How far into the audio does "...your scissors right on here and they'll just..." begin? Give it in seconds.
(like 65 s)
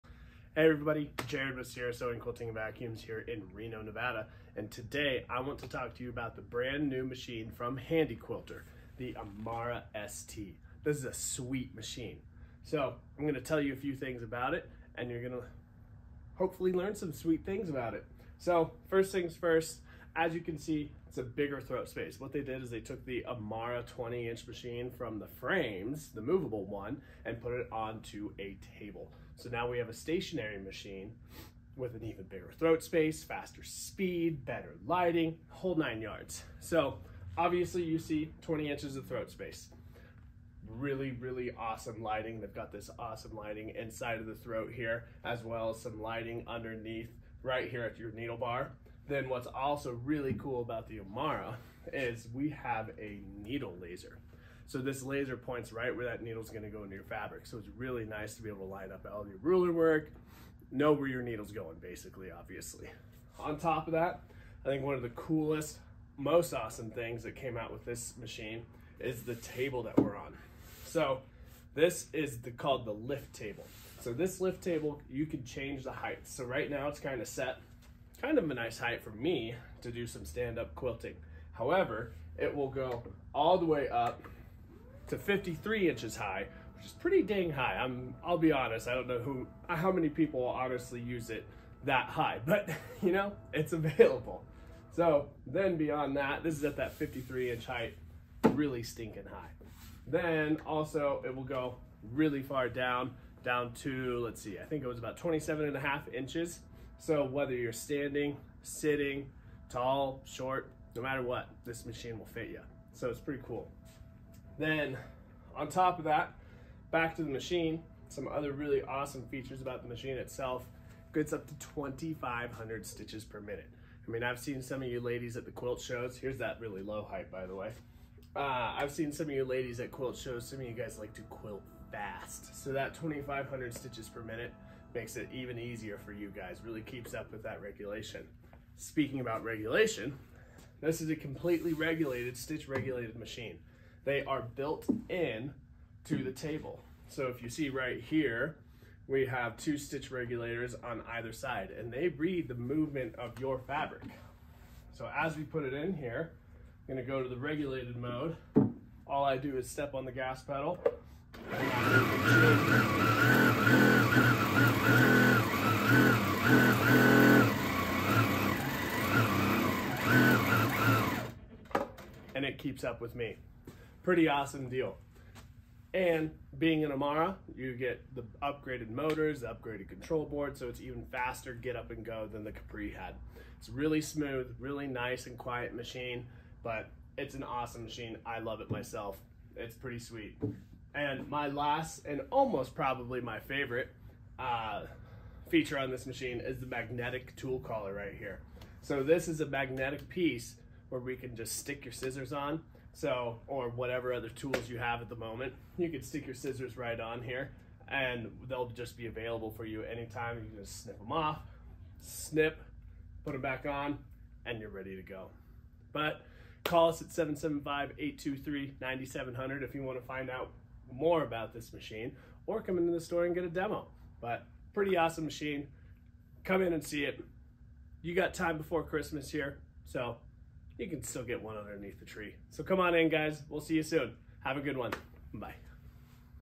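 206 s.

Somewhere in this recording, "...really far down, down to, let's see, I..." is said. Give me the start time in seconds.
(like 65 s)
102 s.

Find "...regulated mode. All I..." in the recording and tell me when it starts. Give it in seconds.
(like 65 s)
157 s.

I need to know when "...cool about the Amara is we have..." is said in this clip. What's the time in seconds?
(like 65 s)
50 s.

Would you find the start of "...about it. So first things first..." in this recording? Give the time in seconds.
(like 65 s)
17 s.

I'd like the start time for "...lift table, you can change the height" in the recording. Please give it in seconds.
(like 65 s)
74 s.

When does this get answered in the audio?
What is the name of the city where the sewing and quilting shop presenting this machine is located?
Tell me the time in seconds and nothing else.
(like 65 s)
3 s.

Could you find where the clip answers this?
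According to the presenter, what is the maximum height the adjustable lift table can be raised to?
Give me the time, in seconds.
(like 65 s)
85 s.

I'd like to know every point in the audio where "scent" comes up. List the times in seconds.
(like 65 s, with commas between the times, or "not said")
not said.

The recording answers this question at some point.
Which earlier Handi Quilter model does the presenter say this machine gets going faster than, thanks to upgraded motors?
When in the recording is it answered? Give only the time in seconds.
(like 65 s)
182 s.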